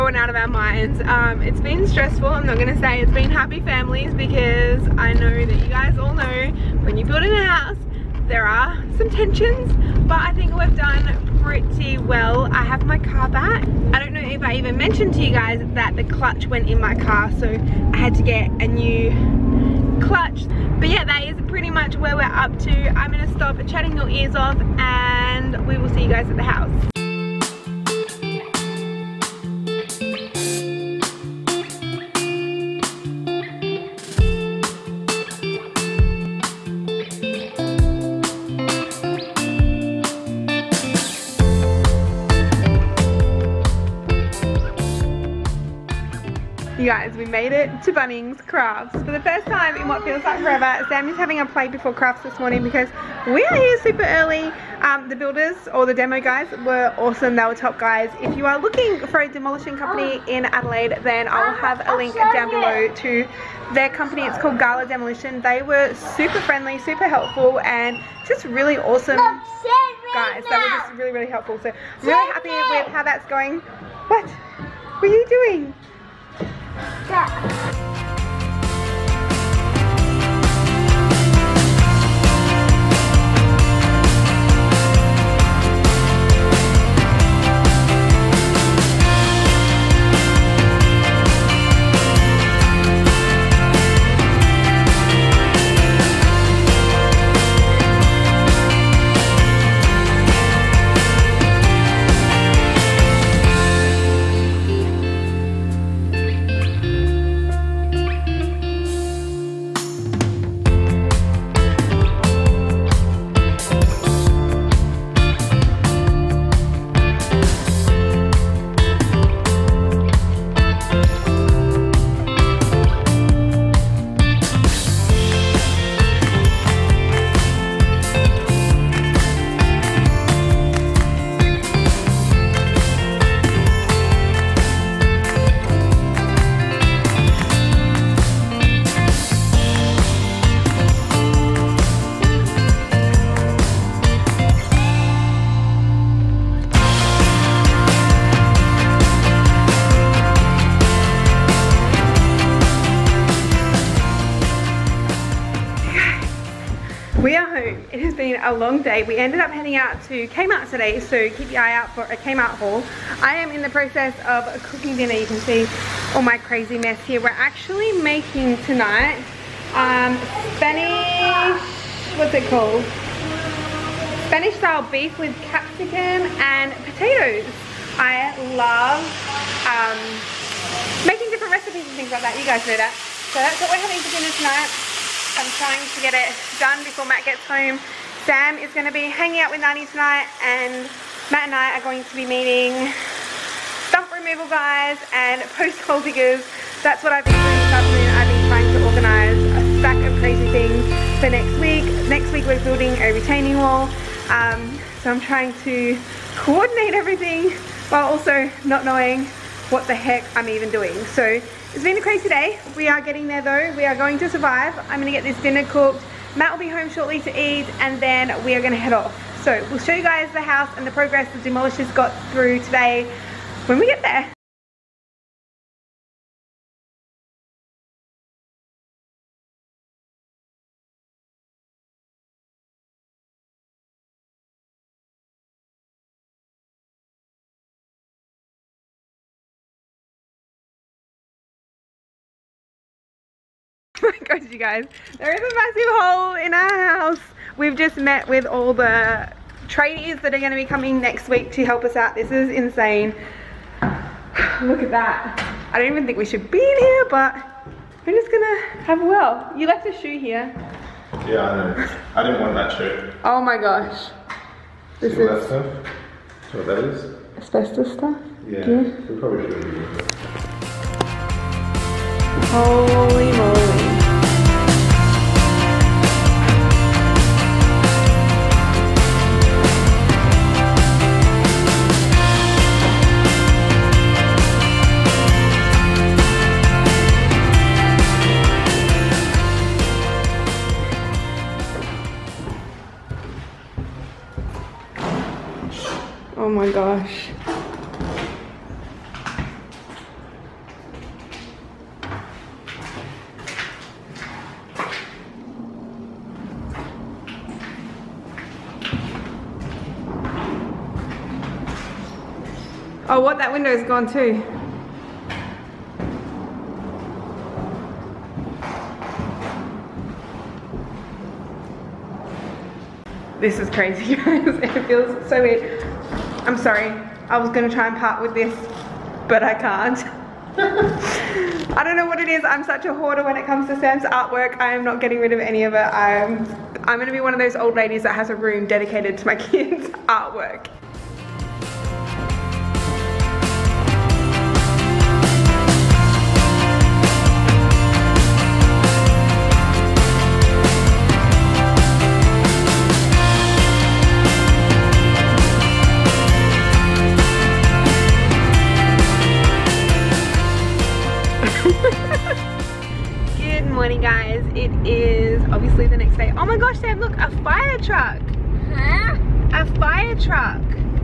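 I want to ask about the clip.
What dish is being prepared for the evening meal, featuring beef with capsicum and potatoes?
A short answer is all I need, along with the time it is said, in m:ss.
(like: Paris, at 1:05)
Spanish style beef, at 2:54.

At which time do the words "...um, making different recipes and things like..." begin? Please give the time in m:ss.
2:59.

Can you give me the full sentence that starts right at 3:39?
So we'll show you guys the house and the progress the demolishers got through today when we get there.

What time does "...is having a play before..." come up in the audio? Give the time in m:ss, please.
0:51.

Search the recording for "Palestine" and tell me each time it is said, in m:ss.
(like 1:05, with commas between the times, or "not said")
not said.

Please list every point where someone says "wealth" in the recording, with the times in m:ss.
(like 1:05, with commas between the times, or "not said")
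not said.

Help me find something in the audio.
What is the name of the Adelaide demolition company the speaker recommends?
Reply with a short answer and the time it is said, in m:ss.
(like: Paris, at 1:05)
Gala Demolition, at 1:04.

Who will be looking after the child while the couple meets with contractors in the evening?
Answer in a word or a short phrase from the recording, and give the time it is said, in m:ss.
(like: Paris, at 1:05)
Nani, at 3:09.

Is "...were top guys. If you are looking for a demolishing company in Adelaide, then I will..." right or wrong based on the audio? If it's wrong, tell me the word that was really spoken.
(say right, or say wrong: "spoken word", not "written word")
right.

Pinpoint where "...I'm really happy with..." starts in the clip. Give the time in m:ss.
1:11.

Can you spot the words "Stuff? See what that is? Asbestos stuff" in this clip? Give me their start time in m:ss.
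4:25.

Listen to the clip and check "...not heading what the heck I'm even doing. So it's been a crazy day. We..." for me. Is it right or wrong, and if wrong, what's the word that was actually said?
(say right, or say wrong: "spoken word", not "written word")
wrong: "knowing", not "heading".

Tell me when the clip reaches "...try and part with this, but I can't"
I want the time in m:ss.
5:27.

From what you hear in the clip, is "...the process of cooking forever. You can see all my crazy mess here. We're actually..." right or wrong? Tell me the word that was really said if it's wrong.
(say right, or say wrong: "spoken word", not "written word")
wrong: "dinner", not "forever".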